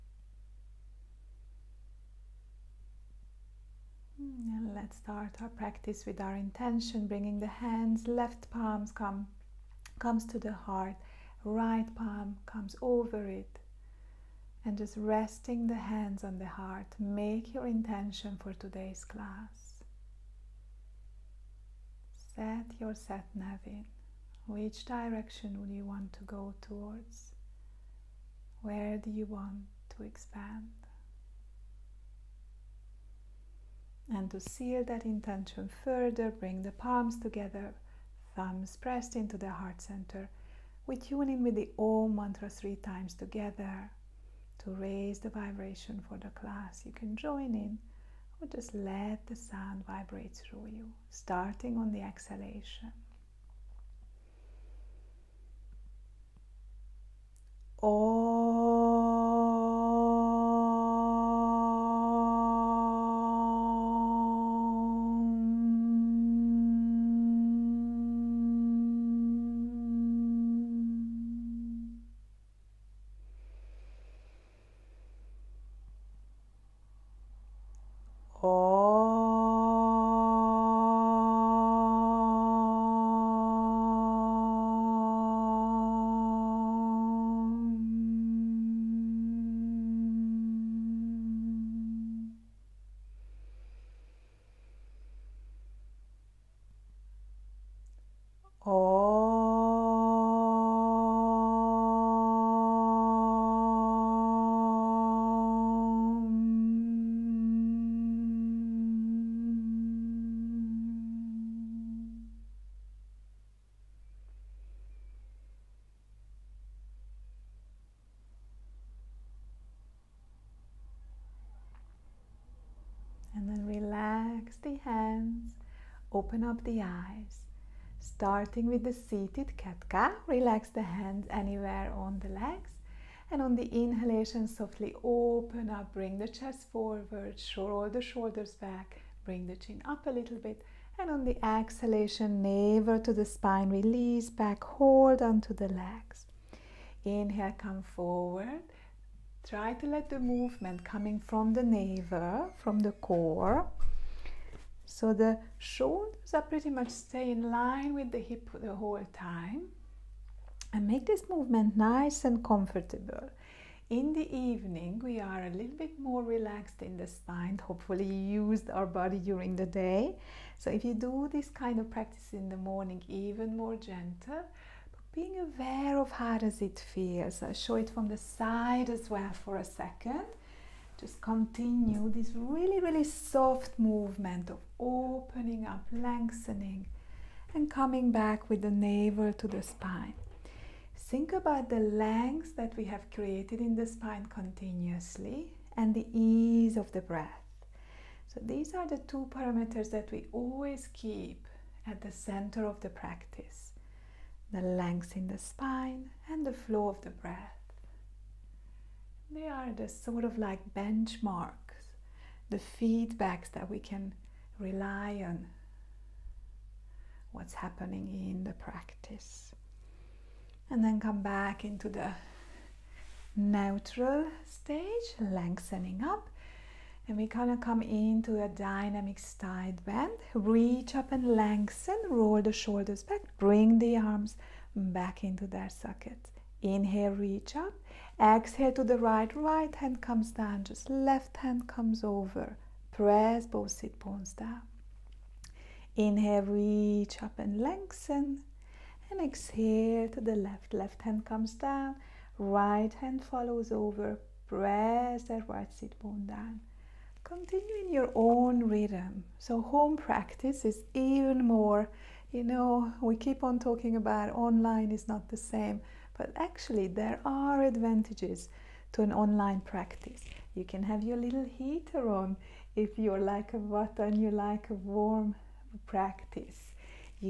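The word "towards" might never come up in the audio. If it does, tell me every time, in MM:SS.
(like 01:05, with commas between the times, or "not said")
00:26.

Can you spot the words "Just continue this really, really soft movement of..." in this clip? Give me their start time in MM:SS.
03:00.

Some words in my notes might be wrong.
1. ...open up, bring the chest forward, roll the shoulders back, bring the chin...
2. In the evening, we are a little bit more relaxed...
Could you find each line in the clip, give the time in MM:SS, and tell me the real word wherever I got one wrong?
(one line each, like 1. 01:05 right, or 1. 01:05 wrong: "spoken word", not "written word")
1. 02:15 right
2. 02:43 right.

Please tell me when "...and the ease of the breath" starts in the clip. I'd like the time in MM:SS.
03:15.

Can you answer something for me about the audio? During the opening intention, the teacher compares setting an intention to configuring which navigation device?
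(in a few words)
satnav.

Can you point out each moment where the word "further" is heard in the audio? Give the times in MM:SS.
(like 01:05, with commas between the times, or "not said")
00:35.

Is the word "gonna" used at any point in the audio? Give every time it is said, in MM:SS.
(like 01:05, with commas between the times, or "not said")
03:47.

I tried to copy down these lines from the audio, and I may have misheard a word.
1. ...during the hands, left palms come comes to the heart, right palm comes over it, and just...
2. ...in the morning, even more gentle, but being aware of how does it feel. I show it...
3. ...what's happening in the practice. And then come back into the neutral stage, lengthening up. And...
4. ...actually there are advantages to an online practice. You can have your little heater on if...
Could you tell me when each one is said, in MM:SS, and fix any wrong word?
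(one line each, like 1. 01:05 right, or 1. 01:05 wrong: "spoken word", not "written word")
1. 00:07 wrong: "bringing", not "during"
2. 02:52 right
3. 03:37 right
4. 04:26 right.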